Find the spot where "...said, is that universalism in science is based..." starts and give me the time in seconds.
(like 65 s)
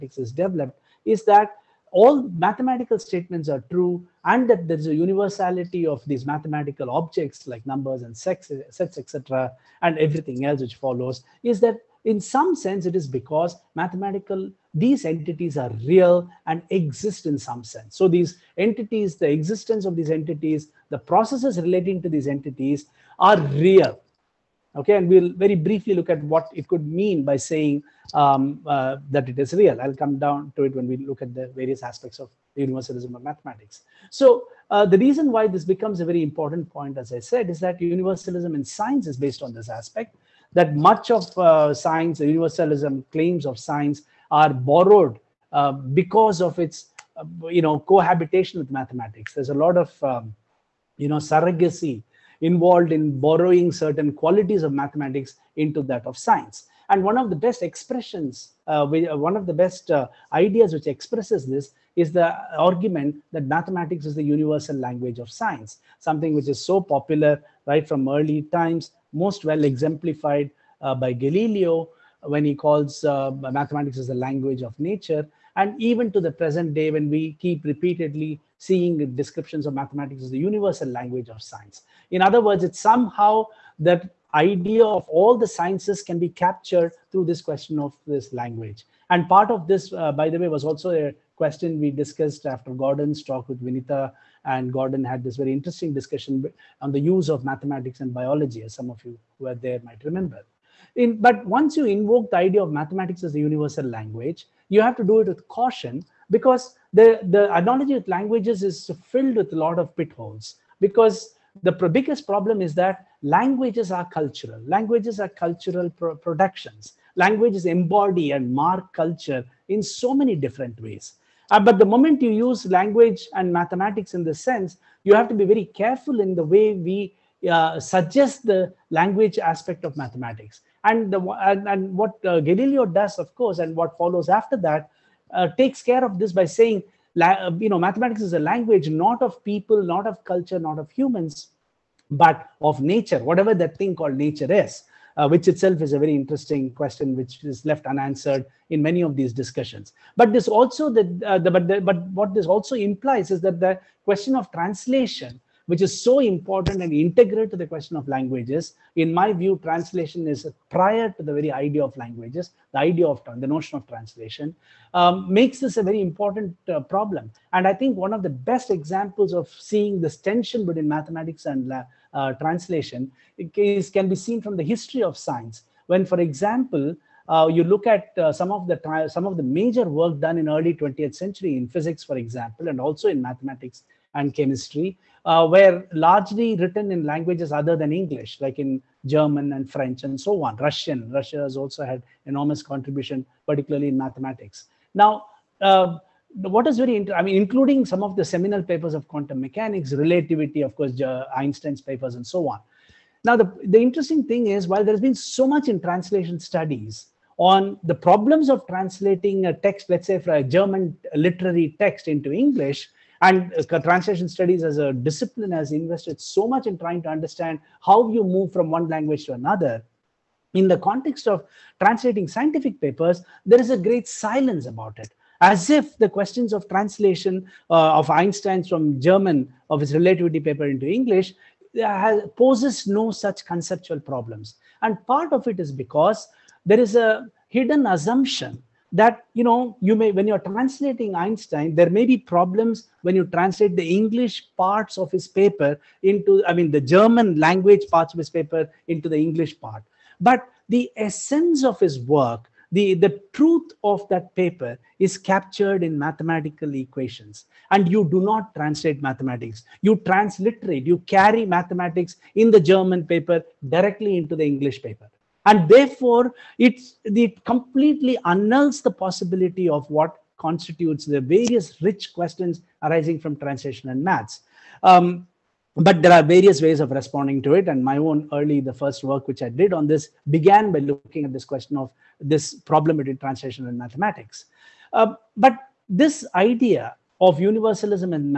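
37 s.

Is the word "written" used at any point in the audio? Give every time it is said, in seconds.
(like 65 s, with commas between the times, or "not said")
186 s.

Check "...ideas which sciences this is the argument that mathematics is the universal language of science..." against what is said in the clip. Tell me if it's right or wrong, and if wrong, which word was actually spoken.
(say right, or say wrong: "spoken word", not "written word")
wrong: "expresses", not "sciences".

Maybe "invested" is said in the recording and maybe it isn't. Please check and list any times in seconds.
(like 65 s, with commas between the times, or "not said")
215 s.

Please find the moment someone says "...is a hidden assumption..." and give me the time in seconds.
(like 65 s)
236 s.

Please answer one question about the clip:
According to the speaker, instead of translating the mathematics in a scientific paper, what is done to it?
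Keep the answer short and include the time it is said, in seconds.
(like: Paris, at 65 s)
Transliterate, at 259 s.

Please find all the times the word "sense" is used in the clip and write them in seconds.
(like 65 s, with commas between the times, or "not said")
12 s, 17 s, 124 s.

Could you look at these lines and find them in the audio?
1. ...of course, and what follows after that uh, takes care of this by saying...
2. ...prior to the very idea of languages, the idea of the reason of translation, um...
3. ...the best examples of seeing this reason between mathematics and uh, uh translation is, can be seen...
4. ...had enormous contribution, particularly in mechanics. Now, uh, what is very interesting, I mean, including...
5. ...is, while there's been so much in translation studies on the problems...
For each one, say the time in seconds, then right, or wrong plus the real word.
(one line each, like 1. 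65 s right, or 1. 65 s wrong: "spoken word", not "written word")
1. 133 s right
2. 160 s wrong: "notion", not "reason"
3. 168 s wrong: "tension", not "reason"
4. 191 s wrong: "mathematics", not "mechanics"
5. 204 s right.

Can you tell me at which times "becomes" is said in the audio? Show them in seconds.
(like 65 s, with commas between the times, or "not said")
35 s.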